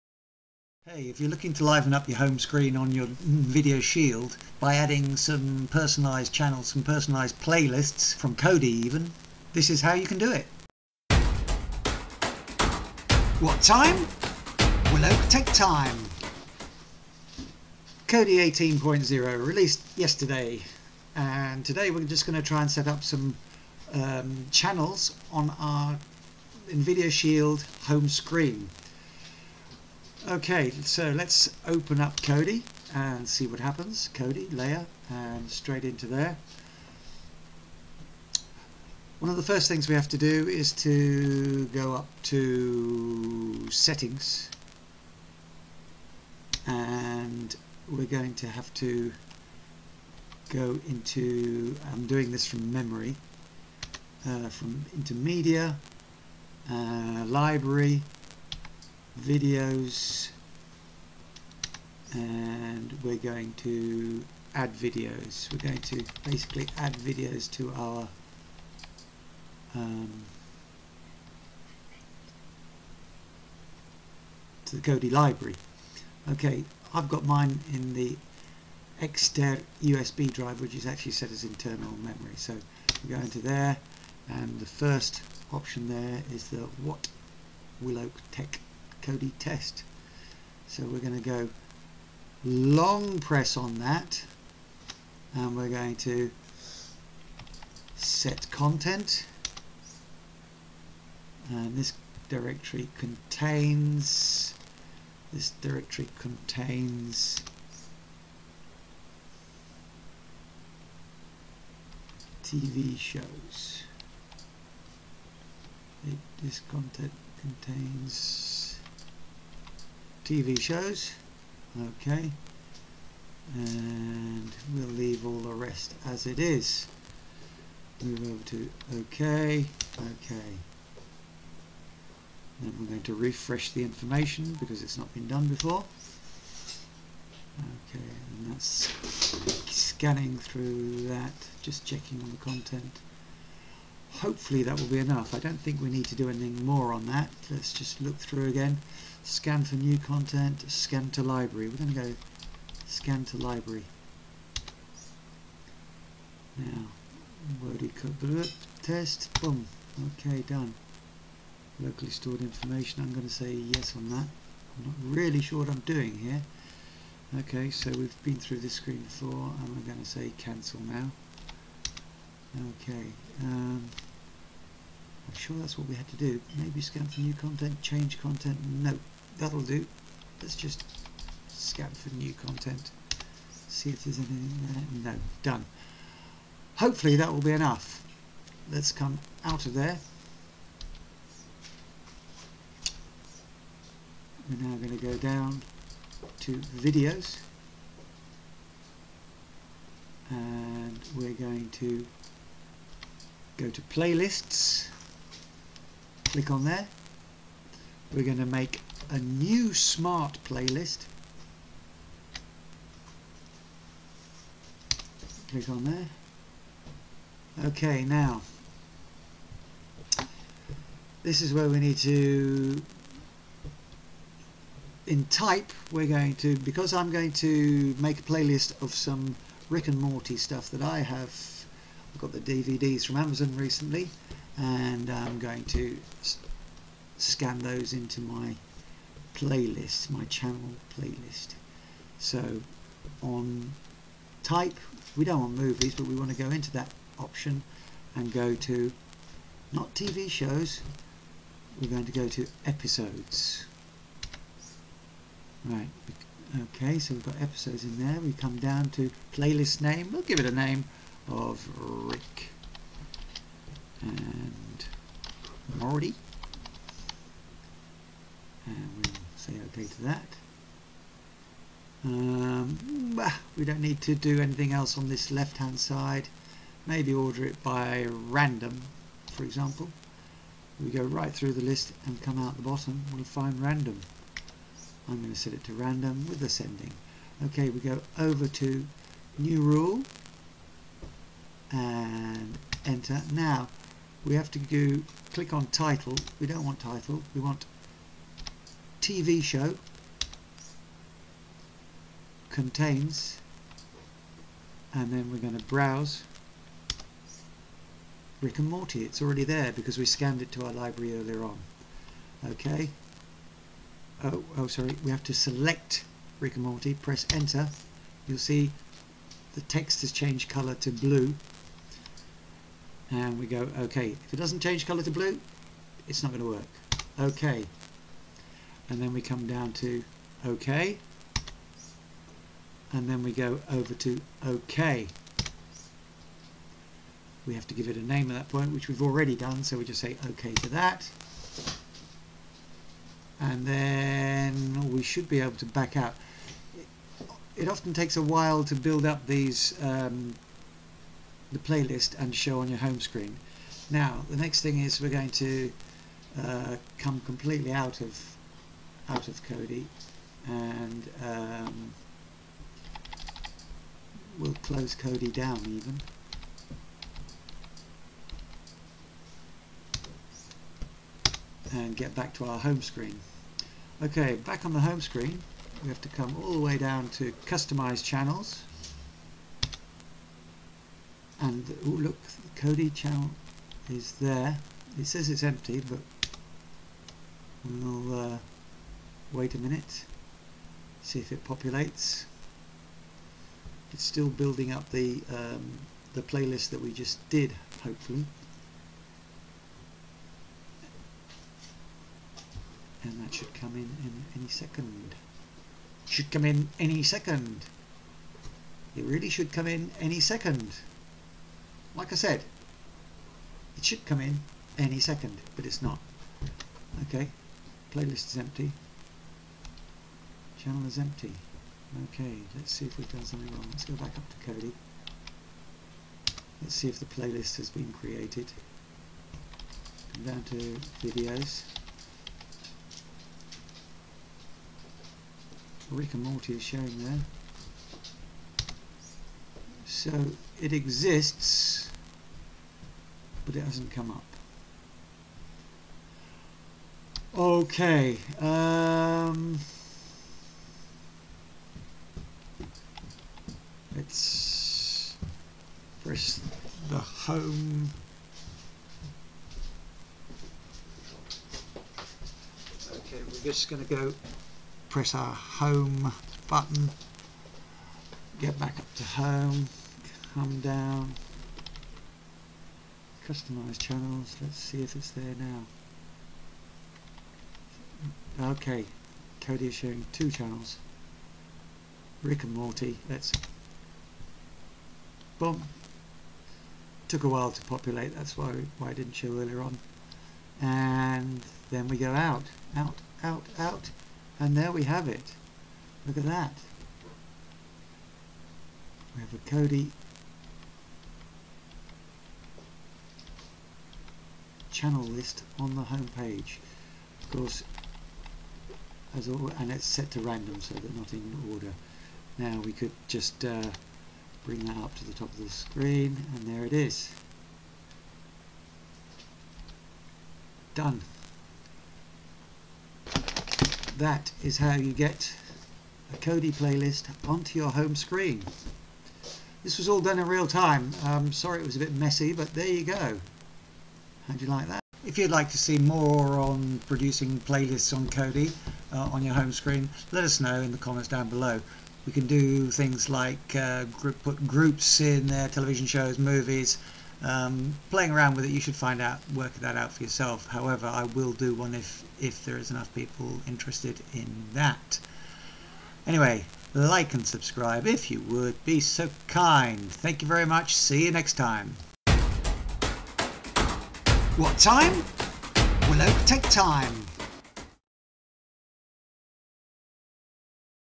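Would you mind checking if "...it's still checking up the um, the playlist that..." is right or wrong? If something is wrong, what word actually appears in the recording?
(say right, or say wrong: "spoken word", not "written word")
wrong: "building", not "checking".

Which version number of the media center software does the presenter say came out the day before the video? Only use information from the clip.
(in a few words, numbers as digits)
18.0.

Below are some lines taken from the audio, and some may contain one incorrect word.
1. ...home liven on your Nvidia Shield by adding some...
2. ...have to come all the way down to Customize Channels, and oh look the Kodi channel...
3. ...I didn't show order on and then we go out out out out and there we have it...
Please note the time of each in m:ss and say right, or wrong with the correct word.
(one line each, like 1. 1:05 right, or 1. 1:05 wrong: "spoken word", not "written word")
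1. 0:02 wrong: "screen", not "liven"
2. 6:15 right
3. 8:08 wrong: "earlier", not "order".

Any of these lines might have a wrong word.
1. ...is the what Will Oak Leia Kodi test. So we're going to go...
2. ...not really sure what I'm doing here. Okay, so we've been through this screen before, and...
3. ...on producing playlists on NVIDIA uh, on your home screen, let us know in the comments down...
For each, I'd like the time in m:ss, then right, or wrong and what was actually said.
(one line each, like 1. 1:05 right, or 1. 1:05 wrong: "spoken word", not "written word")
1. 1:26 wrong: "Tech", not "Leia"
2. 2:44 right
3. 8:56 wrong: "Kodi", not "NVIDIA".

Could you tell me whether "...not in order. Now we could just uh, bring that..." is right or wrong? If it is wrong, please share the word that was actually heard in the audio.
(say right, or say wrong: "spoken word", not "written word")
right.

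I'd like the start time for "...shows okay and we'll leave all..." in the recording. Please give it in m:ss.
2:00.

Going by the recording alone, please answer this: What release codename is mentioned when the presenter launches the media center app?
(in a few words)
Leia.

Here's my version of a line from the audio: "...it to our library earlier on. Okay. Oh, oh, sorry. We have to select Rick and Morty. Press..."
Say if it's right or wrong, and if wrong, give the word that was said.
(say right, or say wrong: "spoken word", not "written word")
right.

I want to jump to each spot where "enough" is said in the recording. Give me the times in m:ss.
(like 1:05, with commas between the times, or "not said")
2:24, 3:07, 9:12.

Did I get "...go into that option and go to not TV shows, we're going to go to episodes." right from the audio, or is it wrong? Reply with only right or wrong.
right.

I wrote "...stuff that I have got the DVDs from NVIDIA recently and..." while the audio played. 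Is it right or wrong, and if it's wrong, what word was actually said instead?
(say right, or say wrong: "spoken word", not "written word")
wrong: "Amazon", not "NVIDIA".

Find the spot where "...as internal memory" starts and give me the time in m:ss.
1:21.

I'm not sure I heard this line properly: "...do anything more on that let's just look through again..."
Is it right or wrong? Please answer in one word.
right.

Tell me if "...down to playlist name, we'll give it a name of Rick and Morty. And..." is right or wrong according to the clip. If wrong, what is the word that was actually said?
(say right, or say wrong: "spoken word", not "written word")
right.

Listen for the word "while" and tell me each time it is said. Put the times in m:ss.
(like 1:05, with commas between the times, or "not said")
5:48, 8:07.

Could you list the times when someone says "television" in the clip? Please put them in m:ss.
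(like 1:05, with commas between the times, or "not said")
9:05.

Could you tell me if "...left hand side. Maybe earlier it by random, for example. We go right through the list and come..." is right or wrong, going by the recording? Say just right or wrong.
wrong.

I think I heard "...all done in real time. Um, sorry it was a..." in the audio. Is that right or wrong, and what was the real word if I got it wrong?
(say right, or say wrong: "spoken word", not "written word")
right.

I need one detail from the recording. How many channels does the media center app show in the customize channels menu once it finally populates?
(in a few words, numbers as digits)
2.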